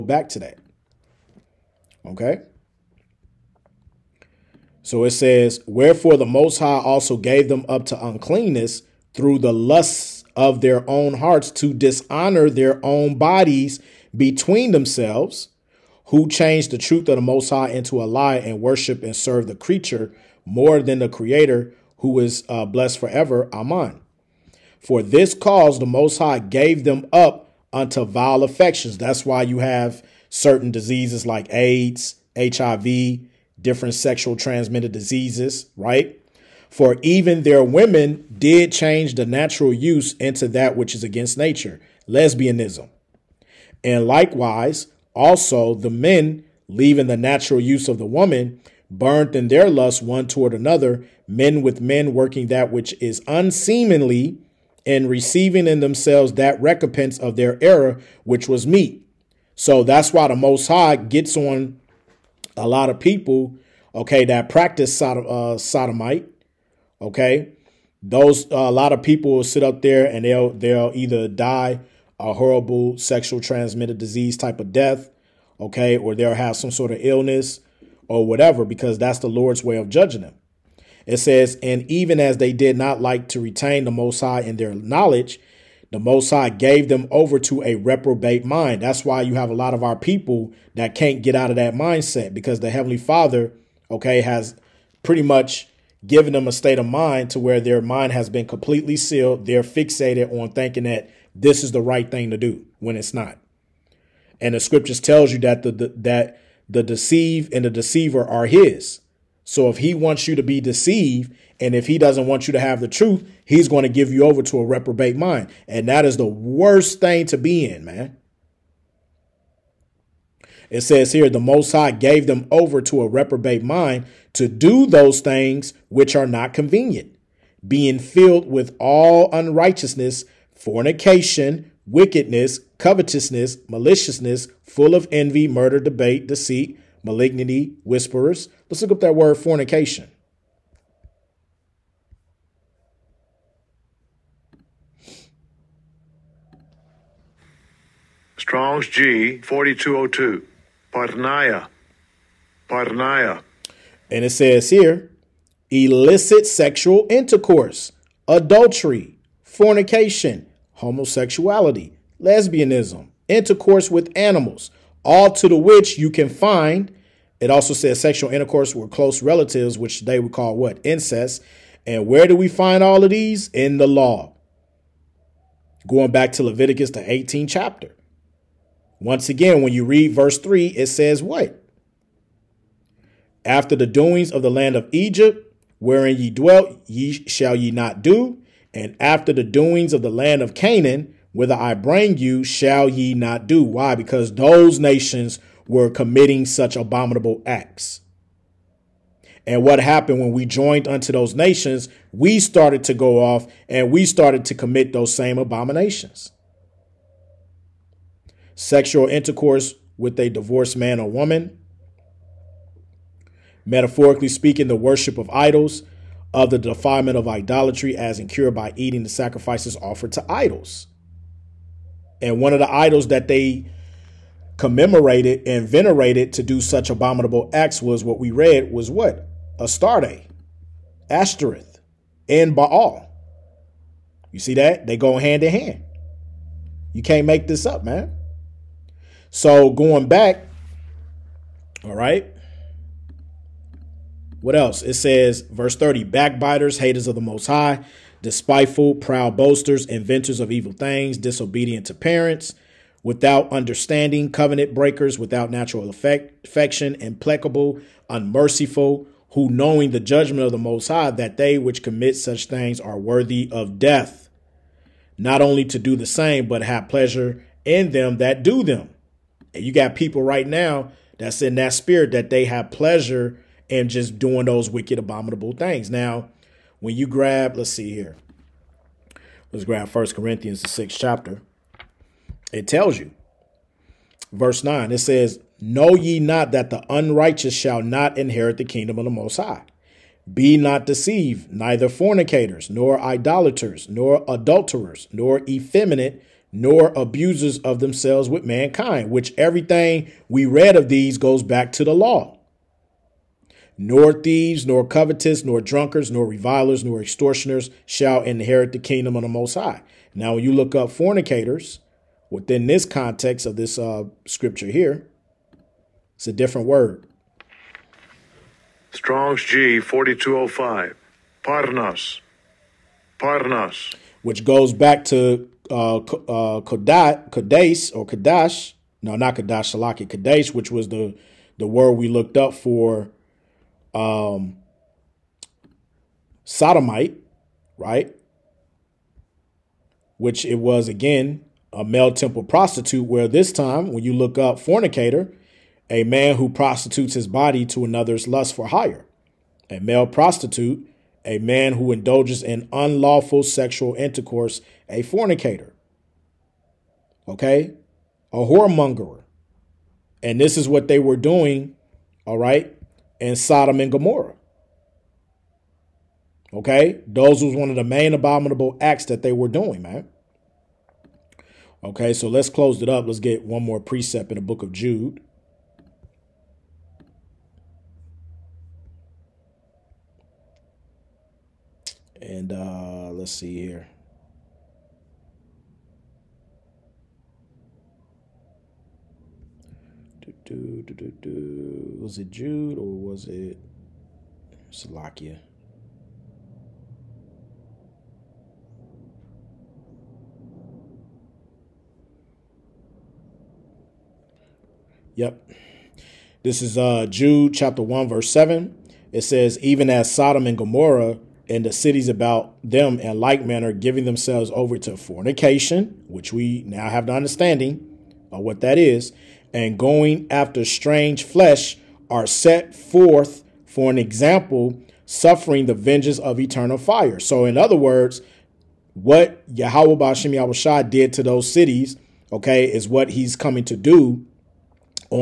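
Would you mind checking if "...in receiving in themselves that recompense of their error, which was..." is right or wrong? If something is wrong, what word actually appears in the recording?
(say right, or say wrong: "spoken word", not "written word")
right.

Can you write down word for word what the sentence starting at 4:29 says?
And you got people right now that's in that spirit that they have pleasure in just doing those wicked, abominable things.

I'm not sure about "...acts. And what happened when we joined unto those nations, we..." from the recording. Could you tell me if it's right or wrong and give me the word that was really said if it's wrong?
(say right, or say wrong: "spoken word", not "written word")
right.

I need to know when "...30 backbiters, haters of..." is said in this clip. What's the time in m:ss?
4:05.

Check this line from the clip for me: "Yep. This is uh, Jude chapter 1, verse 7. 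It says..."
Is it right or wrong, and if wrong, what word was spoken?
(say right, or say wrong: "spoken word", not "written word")
right.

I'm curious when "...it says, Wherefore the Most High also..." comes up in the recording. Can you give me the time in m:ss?
0:05.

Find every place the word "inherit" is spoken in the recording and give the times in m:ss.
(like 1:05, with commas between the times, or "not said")
4:48, 5:08.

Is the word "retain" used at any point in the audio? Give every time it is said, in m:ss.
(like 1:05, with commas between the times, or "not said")
1:23.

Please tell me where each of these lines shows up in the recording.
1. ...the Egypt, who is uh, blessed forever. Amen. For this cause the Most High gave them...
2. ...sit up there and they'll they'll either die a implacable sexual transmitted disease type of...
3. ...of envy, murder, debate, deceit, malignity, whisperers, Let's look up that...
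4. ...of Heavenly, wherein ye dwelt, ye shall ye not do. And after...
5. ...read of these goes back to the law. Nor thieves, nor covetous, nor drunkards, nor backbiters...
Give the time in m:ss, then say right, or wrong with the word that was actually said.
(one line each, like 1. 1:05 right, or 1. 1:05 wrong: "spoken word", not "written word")
1. 0:20 wrong: "Creator", not "Egypt"
2. 1:09 wrong: "horrible", not "implacable"
3. 2:14 right
4. 3:04 wrong: "Egypt", not "Heavenly"
5. 5:00 wrong: "revilers", not "backbiters".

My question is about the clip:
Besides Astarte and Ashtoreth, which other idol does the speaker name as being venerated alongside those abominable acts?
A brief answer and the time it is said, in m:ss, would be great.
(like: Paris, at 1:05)
Baal, at 3:52.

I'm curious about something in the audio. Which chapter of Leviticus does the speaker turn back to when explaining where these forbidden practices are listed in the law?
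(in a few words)
18th.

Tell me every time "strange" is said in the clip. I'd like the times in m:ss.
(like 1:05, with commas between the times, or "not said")
7:00.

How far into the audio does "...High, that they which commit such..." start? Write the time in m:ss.
4:20.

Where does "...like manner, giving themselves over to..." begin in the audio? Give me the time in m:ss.
6:53.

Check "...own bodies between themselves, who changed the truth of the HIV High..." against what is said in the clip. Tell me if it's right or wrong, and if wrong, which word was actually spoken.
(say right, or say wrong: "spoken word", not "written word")
wrong: "Most", not "HIV".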